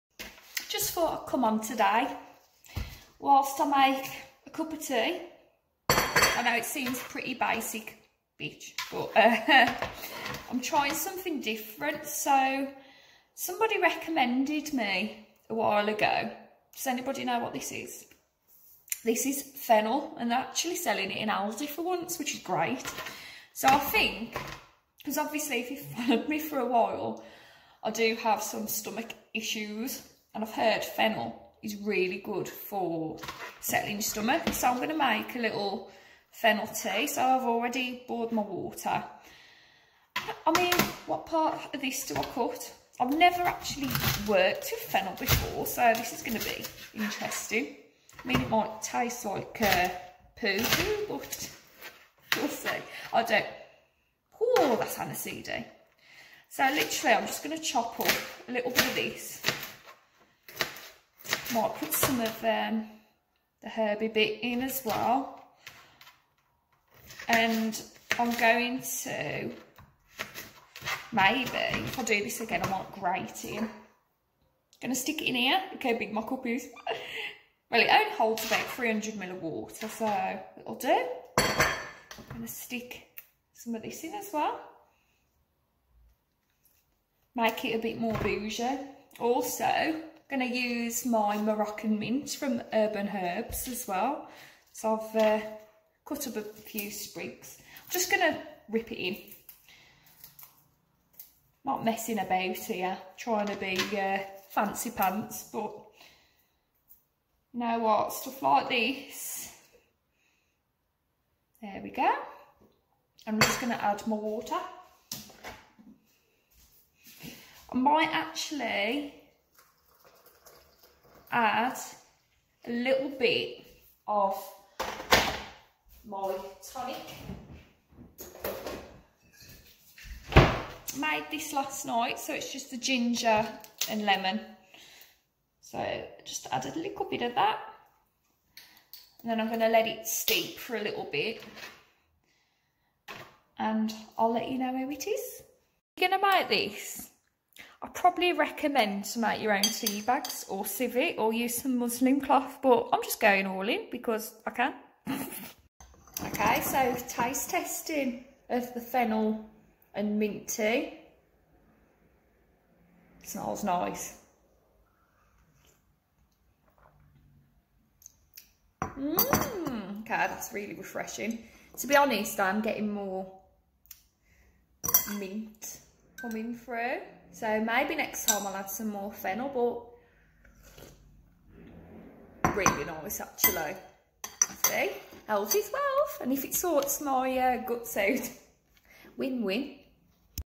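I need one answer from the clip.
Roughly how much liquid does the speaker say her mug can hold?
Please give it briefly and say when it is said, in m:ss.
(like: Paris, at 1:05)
300 ml, at 1:18.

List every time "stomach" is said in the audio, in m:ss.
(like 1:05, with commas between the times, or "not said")
0:28, 0:34.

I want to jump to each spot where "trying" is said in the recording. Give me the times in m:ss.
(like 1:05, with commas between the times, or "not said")
0:10, 1:43.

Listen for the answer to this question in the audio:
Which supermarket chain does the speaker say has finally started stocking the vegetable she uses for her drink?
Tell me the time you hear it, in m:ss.
0:21.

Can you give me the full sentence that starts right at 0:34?
So I'm going to make a little fennel tea.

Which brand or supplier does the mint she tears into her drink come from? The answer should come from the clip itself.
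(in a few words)
Urban Herbs.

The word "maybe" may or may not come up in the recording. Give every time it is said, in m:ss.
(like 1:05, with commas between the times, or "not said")
1:11, 2:57.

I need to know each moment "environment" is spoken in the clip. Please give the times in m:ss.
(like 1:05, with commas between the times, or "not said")
not said.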